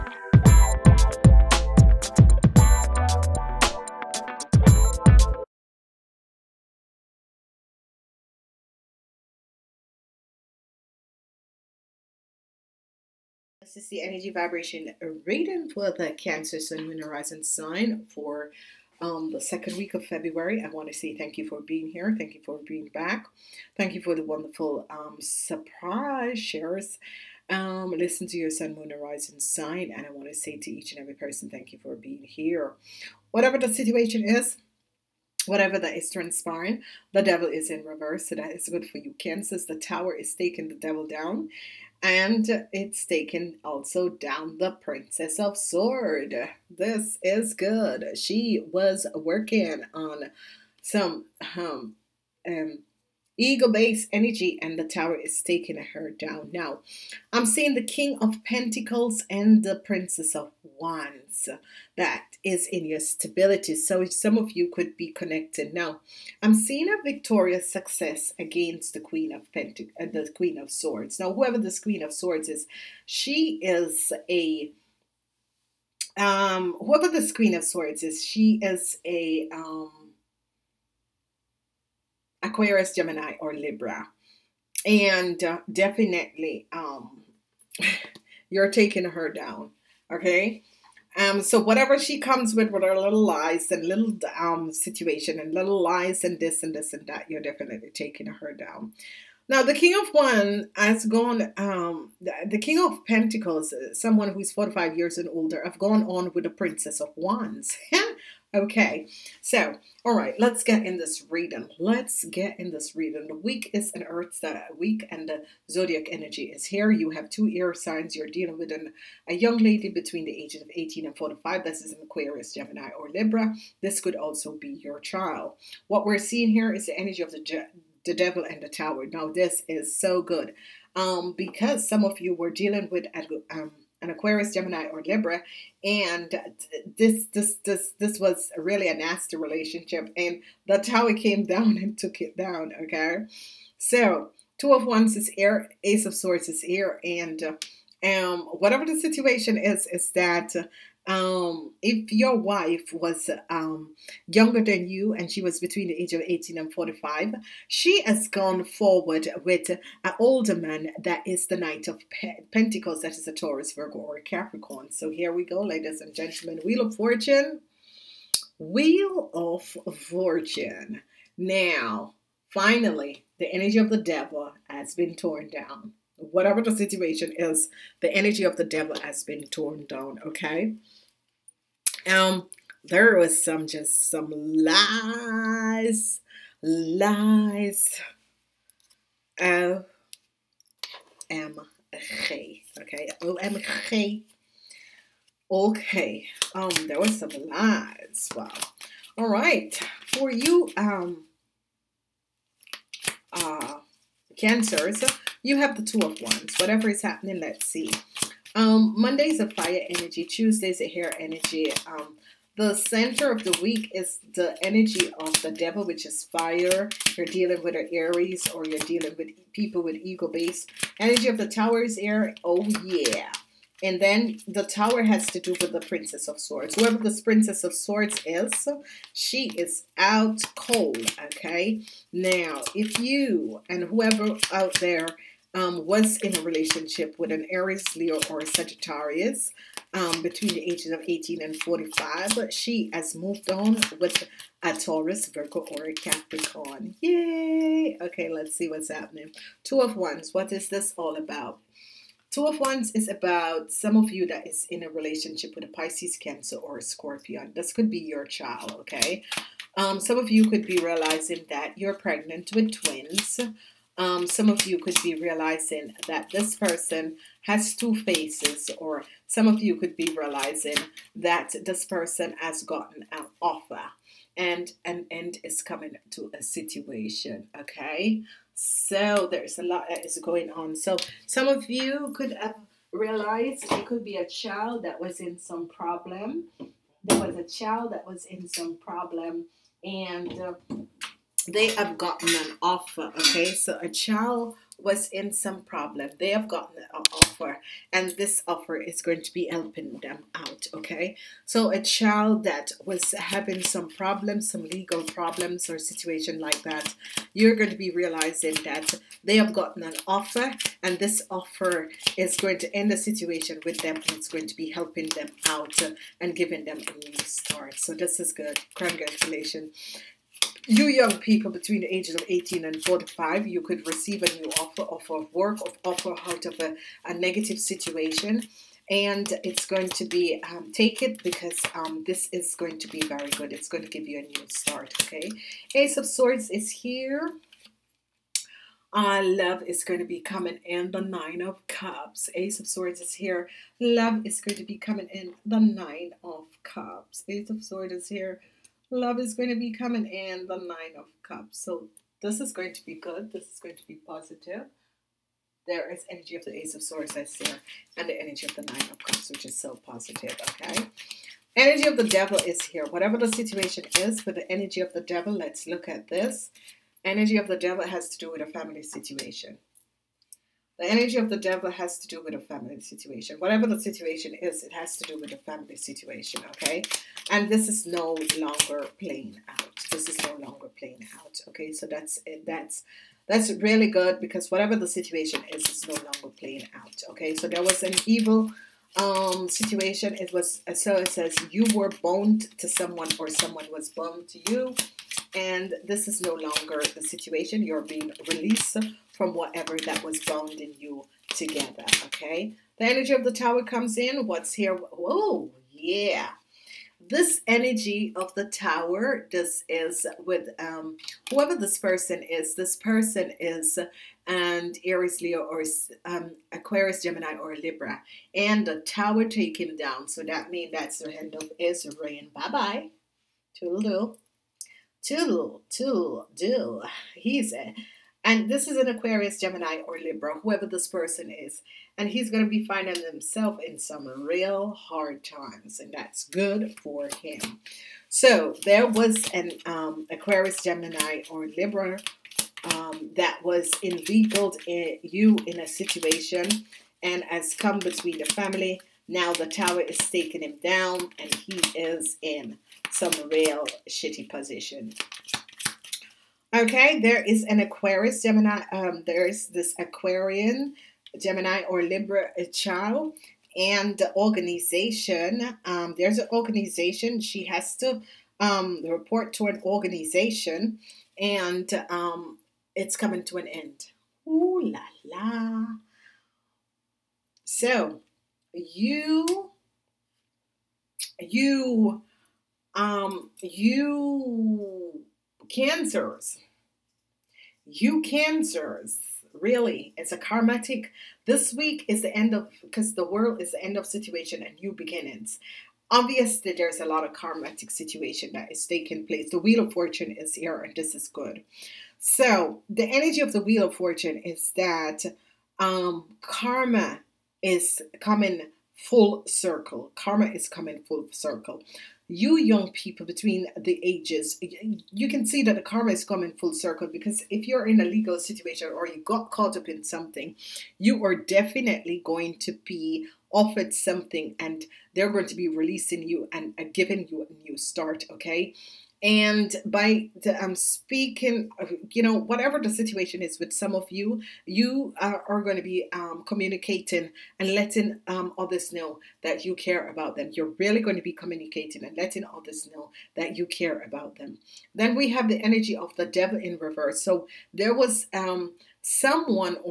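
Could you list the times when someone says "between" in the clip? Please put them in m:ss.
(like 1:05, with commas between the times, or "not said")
1:59, 2:35, 4:00, 5:21, 7:27, 8:33.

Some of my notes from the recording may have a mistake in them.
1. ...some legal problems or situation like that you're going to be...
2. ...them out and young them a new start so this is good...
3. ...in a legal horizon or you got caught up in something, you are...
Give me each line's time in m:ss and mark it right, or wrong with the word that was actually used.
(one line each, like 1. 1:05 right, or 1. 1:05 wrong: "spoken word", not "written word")
1. 5:04 right
2. 5:15 wrong: "giving", not "young"
3. 8:37 wrong: "situation", not "horizon".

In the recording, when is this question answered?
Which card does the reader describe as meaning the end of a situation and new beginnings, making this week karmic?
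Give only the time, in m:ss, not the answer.
8:12.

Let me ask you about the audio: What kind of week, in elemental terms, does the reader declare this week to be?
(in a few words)
Earth week.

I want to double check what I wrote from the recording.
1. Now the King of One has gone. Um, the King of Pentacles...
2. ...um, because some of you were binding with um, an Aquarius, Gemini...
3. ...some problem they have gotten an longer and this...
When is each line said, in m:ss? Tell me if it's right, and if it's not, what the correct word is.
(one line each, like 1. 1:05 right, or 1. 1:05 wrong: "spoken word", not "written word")
1. 1:39 right
2. 2:10 wrong: "dealing", not "binding"
3. 4:55 wrong: "offer", not "longer".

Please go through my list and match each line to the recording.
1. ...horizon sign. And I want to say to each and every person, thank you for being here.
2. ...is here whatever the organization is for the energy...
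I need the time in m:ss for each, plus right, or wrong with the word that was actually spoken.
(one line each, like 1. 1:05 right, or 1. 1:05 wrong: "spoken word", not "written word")
1. 0:28 right
2. 6:02 wrong: "situation", not "organization".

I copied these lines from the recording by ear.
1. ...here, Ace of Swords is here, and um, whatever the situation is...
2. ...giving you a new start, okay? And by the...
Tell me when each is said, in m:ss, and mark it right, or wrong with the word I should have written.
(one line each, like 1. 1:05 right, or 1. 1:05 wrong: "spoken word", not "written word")
1. 2:25 right
2. 8:46 right.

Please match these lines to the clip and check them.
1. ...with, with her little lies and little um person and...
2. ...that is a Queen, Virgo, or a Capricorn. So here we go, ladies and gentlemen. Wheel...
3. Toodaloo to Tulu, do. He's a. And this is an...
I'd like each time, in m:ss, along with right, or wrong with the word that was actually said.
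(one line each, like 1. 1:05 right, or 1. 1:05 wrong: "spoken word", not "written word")
1. 1:32 wrong: "situation", not "person"
2. 2:43 wrong: "Taurus", not "Queen"
3. 7:03 right.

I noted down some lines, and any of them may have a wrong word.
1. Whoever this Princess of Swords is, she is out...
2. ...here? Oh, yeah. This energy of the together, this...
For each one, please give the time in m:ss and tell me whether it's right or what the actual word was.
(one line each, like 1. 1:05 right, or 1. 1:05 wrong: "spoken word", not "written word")
1. 3:46 right
2. 6:44 wrong: "tower", not "together".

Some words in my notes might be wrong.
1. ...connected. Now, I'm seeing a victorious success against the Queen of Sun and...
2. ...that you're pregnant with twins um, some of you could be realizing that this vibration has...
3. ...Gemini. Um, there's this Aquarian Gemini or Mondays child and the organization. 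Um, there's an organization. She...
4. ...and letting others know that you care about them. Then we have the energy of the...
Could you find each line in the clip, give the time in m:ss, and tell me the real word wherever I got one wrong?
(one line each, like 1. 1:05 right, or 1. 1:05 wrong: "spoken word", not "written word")
1. 1:05 wrong: "Pentacles", not "Sun"
2. 4:21 wrong: "person", not "vibration"
3. 7:38 wrong: "Libra", not "Mondays"
4. 9:01 right.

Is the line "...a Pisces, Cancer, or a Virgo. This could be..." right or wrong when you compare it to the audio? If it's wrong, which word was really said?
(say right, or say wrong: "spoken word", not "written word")
wrong: "Scorpion", not "Virgo".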